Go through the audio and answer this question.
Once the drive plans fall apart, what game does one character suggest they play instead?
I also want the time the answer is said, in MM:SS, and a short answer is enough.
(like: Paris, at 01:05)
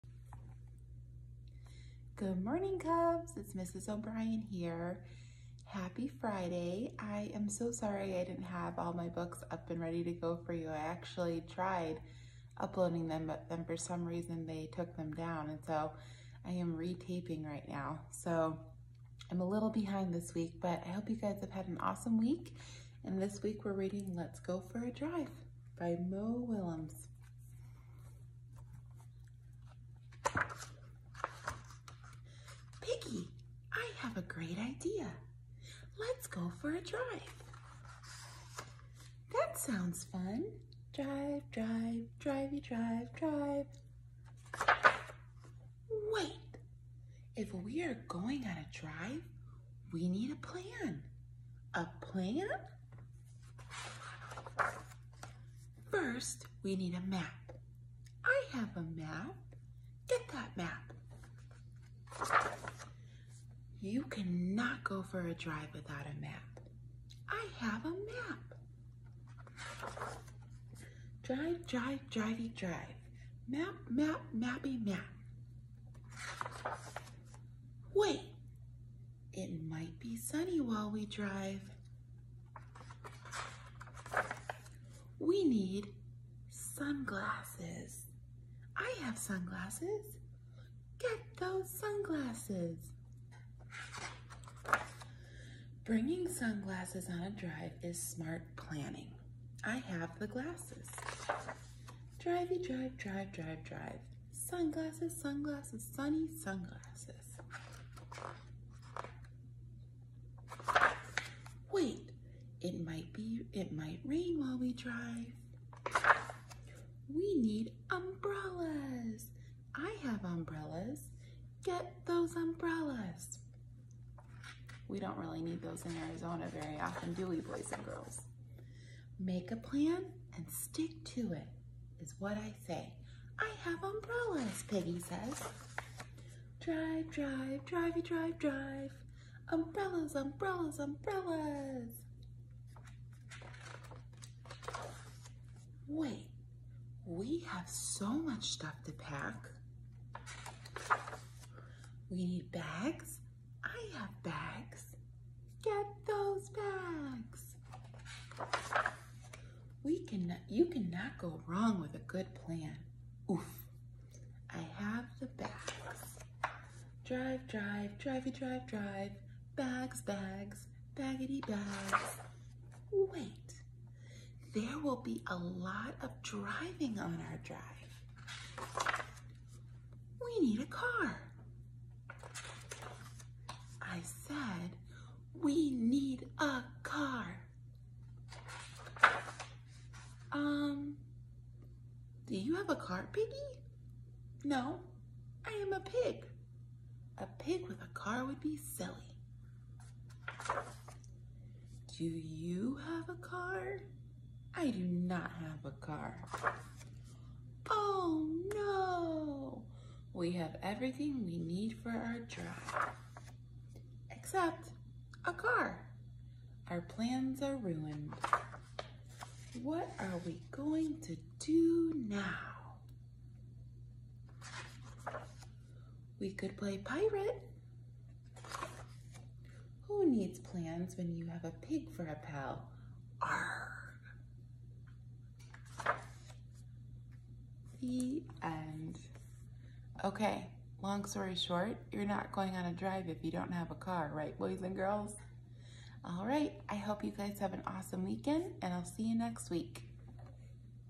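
Pirate, at 03:46.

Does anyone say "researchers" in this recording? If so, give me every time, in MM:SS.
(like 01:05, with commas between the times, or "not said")
not said.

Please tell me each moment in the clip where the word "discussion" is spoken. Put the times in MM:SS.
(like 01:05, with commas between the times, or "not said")
not said.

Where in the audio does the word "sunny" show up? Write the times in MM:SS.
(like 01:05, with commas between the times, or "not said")
01:20, 01:45.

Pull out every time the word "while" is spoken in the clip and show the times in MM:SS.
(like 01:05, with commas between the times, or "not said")
01:20, 01:54.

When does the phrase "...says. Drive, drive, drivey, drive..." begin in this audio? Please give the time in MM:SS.
02:14.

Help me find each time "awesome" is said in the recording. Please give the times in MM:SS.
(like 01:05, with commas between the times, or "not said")
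00:21, 04:07.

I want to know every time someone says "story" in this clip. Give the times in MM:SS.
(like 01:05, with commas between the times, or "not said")
04:01.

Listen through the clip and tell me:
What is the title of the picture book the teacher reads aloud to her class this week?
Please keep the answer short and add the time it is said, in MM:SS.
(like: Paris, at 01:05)
Let's Go for a Drive, at 00:24.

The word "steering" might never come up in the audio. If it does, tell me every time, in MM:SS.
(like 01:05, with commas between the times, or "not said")
not said.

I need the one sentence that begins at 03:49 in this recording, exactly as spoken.
Who needs plans when you have a pig for a pal?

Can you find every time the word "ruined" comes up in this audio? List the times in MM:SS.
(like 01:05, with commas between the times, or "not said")
03:37.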